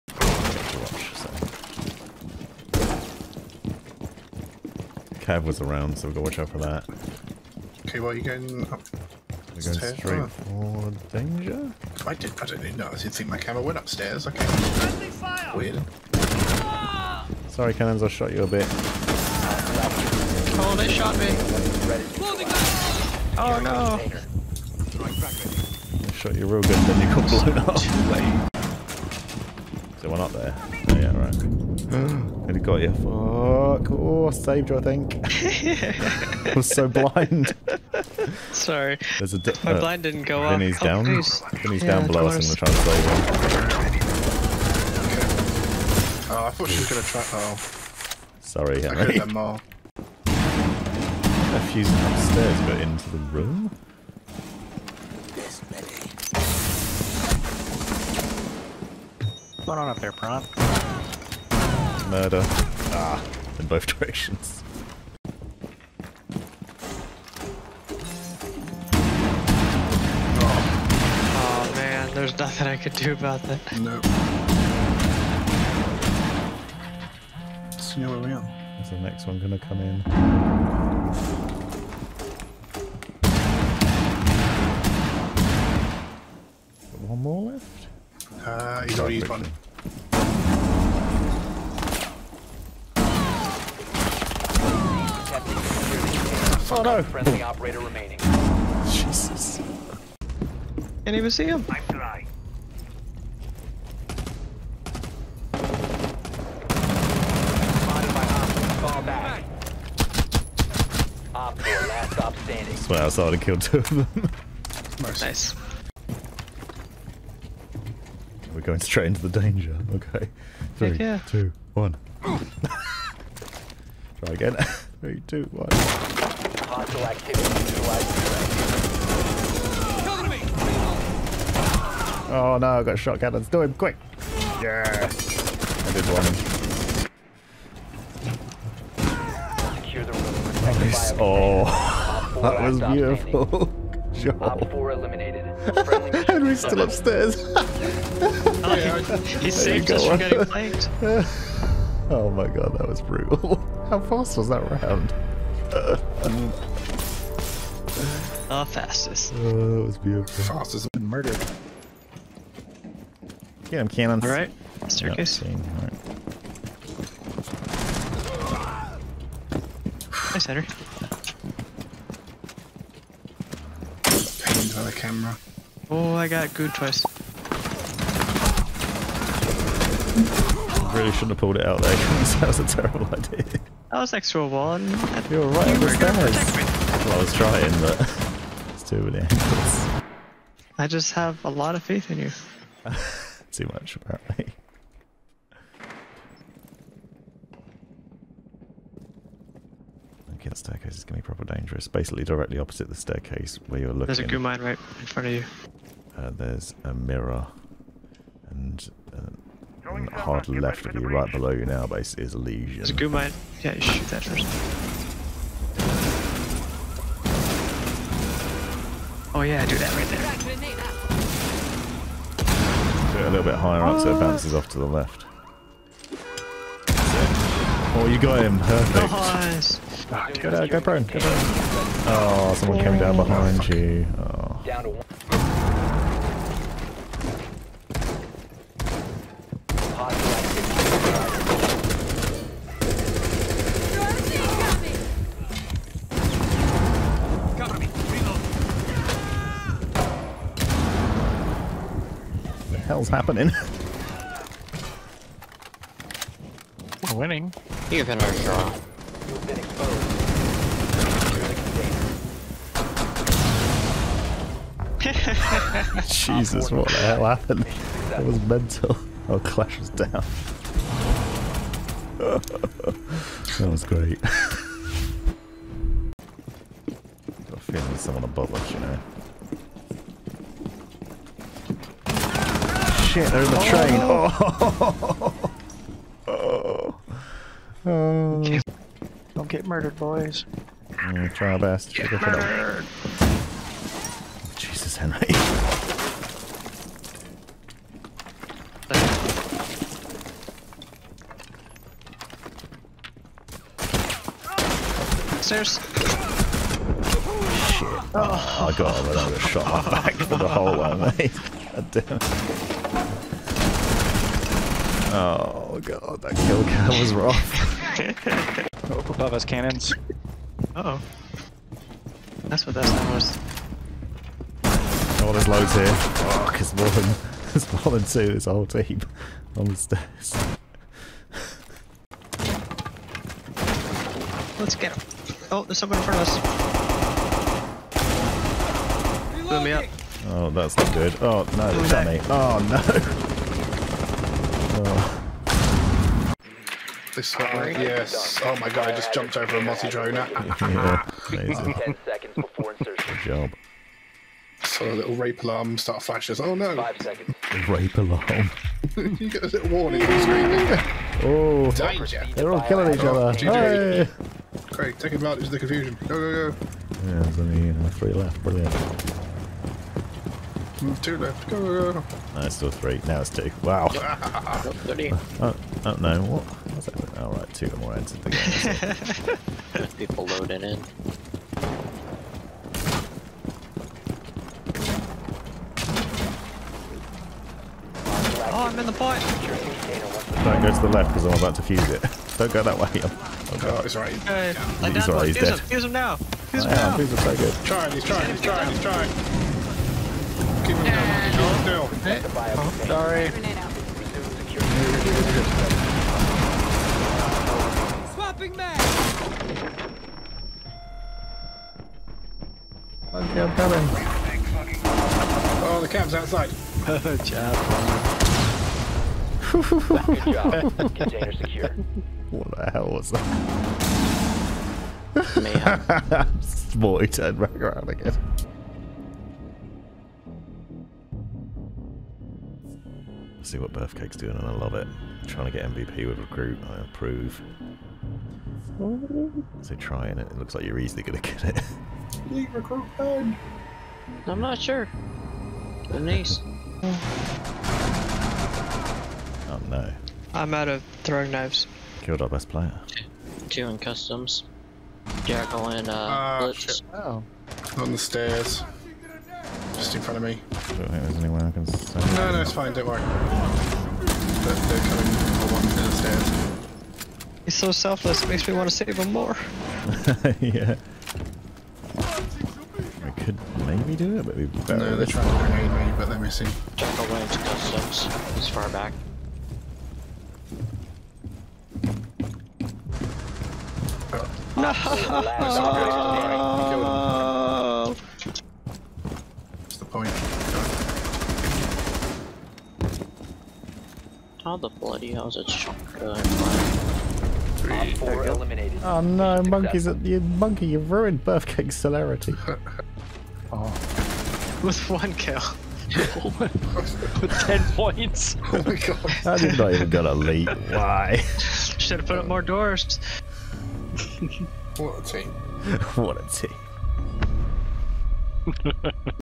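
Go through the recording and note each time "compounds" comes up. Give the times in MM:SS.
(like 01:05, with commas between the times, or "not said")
not said.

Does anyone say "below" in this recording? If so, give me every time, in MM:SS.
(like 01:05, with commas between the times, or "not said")
00:42, 03:31.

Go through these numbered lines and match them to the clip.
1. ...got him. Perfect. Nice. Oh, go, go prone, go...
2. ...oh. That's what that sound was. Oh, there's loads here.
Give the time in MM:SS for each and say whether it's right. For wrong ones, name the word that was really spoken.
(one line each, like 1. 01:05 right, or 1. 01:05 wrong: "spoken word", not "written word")
1. 03:48 right
2. 05:20 right.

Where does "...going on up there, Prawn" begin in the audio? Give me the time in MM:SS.
00:59.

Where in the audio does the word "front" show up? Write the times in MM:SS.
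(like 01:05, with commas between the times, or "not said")
03:25, 05:36, 07:40.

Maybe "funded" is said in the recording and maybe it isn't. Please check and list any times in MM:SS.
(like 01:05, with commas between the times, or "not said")
not said.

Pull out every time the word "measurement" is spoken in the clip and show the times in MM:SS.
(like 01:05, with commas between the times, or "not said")
not said.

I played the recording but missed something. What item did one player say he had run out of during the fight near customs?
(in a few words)
throwing knives.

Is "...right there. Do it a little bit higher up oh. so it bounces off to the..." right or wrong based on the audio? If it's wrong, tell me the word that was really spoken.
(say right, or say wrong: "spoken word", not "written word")
right.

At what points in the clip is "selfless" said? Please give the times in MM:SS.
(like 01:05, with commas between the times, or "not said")
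07:47.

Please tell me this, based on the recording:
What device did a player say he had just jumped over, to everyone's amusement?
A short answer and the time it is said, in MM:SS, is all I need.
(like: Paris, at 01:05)
multi-drone, at 05:49.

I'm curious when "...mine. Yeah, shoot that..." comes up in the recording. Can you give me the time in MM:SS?
03:33.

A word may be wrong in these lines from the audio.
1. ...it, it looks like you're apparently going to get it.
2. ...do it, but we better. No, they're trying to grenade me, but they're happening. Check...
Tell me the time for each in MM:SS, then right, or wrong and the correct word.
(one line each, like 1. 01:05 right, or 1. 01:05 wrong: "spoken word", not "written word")
1. 07:20 wrong: "easily", not "apparently"
2. 07:53 wrong: "missing", not "happening".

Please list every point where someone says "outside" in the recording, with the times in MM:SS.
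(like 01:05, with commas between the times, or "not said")
06:56.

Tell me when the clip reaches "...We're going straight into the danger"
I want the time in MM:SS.
01:58.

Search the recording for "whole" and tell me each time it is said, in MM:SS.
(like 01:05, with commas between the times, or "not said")
05:10, 05:28.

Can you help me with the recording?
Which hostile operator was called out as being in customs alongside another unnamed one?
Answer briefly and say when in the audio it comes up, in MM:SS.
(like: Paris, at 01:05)
Jackal, at 07:35.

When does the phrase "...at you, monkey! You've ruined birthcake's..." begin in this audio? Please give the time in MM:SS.
08:19.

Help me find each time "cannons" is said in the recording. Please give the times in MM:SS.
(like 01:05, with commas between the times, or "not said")
00:17, 02:43, 05:19.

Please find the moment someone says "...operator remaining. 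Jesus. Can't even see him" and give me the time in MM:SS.
01:37.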